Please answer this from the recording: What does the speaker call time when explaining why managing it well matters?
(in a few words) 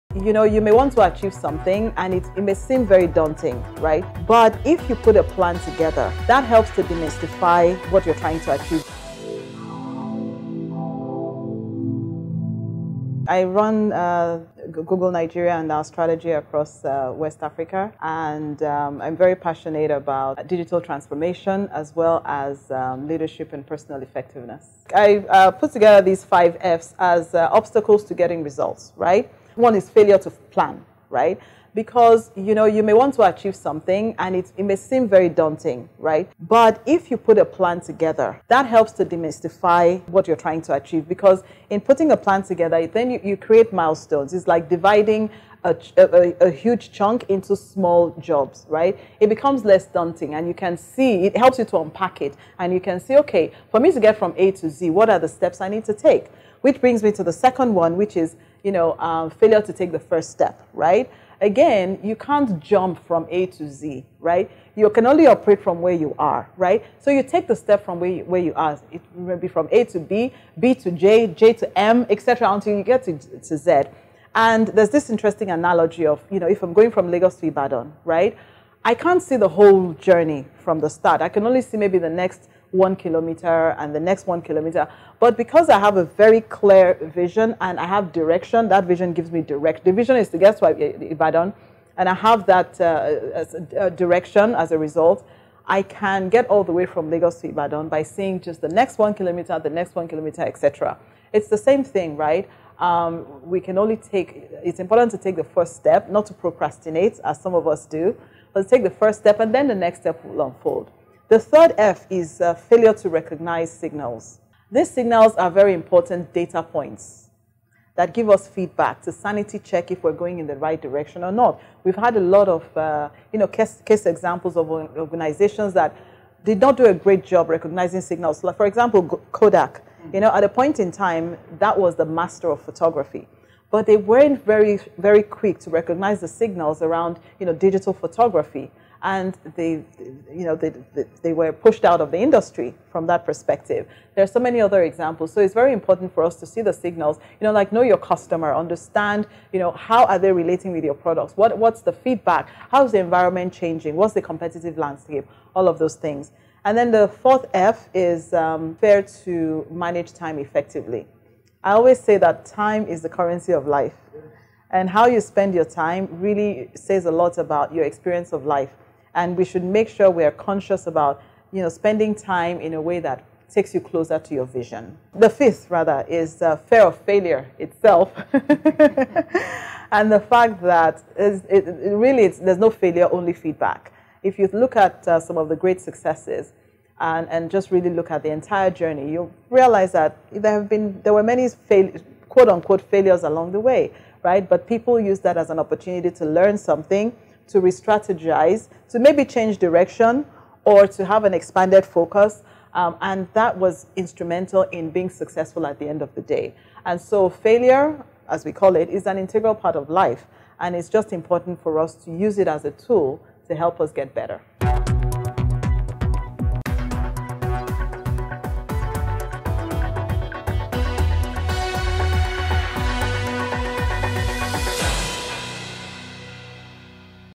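the currency of life.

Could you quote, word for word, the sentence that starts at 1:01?
again, you can't jump from A to Z, right?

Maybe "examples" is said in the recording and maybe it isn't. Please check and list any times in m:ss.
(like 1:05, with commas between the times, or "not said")
2:04, 2:08, 2:24.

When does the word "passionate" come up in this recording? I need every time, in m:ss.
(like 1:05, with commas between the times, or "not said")
0:19.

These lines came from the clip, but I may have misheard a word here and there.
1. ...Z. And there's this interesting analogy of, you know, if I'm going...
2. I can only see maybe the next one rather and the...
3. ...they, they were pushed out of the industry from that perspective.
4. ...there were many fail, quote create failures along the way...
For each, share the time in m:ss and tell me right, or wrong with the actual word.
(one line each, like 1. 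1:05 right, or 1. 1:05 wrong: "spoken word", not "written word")
1. 1:13 right
2. 1:21 wrong: "kilometer", not "rather"
3. 2:20 right
4. 3:11 wrong: "unquote", not "create".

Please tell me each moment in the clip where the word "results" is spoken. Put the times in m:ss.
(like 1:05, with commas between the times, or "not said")
0:28, 1:34.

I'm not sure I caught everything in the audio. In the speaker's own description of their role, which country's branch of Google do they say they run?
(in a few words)
Nigeria.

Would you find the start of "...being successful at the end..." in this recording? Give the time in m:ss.
3:24.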